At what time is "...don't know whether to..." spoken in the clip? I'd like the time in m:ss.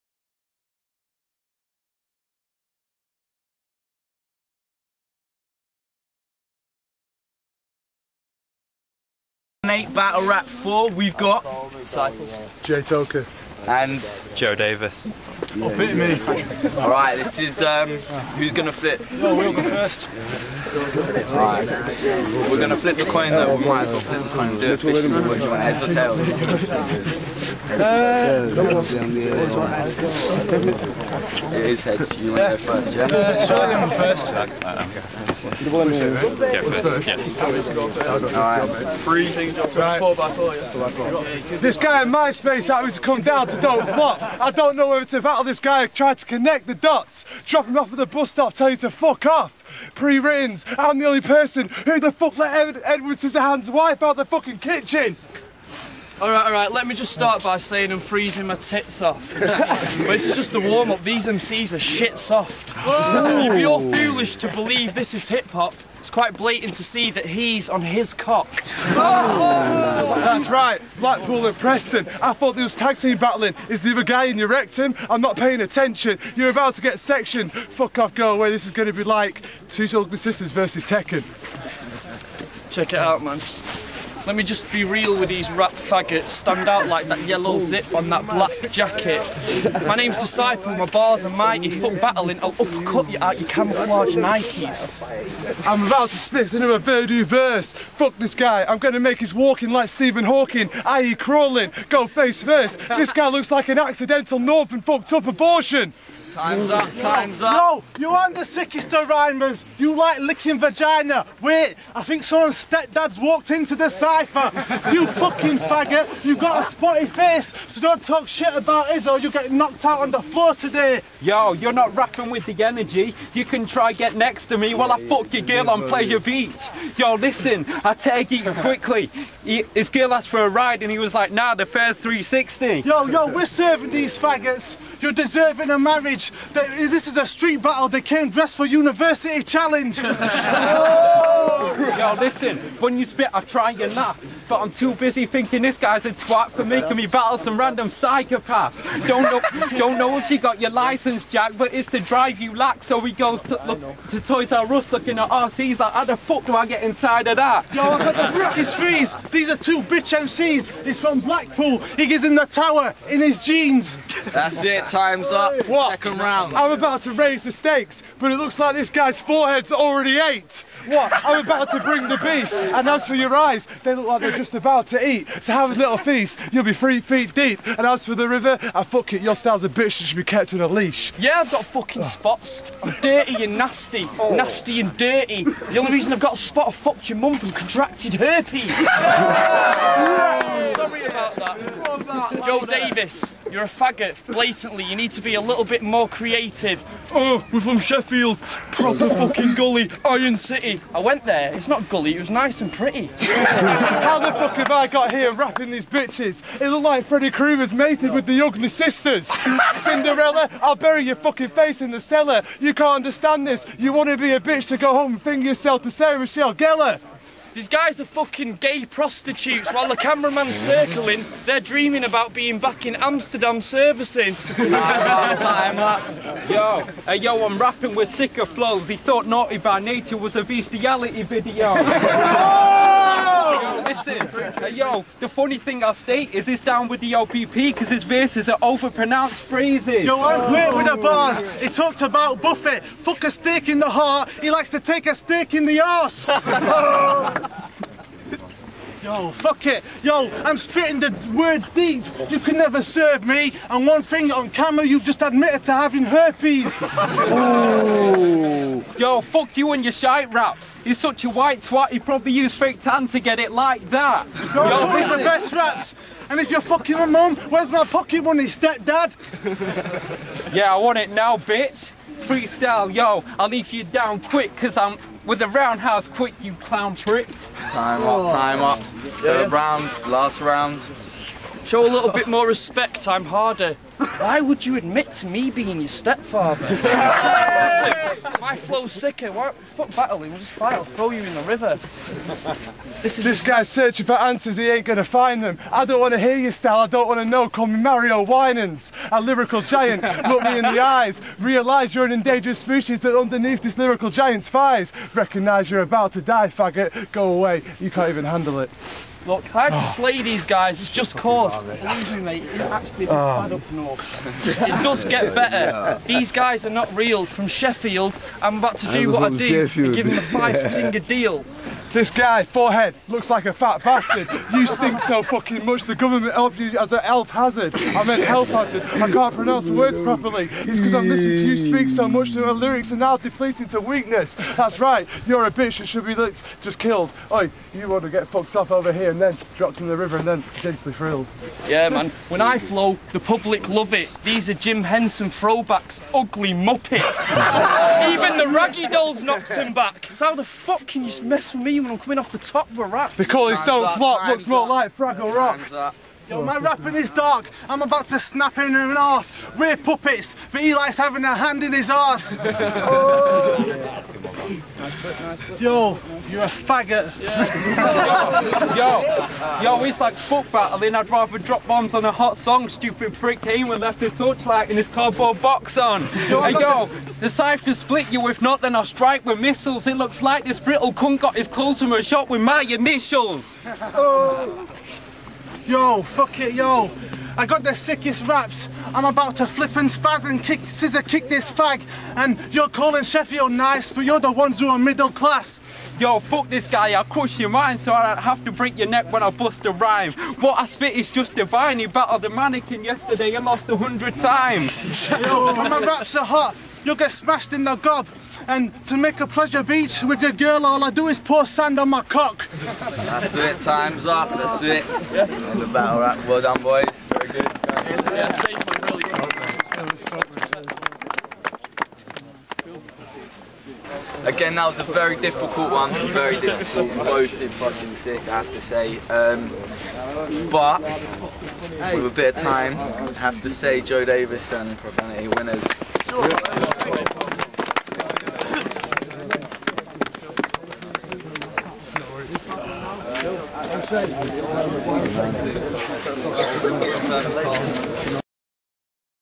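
0:44.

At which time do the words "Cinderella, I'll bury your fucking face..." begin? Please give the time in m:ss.
3:29.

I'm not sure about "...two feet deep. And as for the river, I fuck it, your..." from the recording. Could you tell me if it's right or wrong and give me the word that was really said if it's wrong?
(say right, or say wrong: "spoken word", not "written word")
wrong: "three", not "two".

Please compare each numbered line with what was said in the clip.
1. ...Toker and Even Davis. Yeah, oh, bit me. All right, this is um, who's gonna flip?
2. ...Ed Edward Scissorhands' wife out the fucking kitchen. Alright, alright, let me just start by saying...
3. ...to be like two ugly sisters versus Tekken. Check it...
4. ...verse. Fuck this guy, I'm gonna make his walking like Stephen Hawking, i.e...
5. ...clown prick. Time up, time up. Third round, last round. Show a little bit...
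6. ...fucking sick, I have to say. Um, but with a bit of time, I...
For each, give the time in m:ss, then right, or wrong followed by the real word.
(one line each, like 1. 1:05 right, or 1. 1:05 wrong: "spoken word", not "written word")
1. 0:12 wrong: "Joe", not "Even"
2. 0:52 right
3. 1:18 right
4. 1:37 right
5. 4:36 right
6. 7:07 right.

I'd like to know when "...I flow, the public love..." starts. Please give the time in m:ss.
5:42.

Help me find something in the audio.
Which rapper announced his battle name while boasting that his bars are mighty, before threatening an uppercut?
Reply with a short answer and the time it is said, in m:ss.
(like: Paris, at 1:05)
Disciple, at 1:30.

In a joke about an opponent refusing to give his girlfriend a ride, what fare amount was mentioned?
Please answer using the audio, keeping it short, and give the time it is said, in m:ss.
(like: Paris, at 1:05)
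360, at 2:11.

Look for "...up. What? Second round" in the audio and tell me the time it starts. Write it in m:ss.
2:45.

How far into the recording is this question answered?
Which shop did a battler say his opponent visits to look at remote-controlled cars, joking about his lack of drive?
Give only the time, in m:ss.
2:34.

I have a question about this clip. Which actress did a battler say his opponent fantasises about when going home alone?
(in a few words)
Sarah Michelle Gellar.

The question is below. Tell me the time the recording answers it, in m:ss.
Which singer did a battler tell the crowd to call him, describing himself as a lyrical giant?
4:57.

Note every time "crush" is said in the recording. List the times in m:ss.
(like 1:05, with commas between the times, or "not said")
6:37.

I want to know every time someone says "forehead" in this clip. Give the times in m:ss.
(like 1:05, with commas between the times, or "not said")
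2:49, 5:22.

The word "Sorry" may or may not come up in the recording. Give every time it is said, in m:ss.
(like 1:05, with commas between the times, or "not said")
3:08.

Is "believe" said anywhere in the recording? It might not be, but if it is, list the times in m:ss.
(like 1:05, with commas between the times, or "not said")
1:04, 5:11.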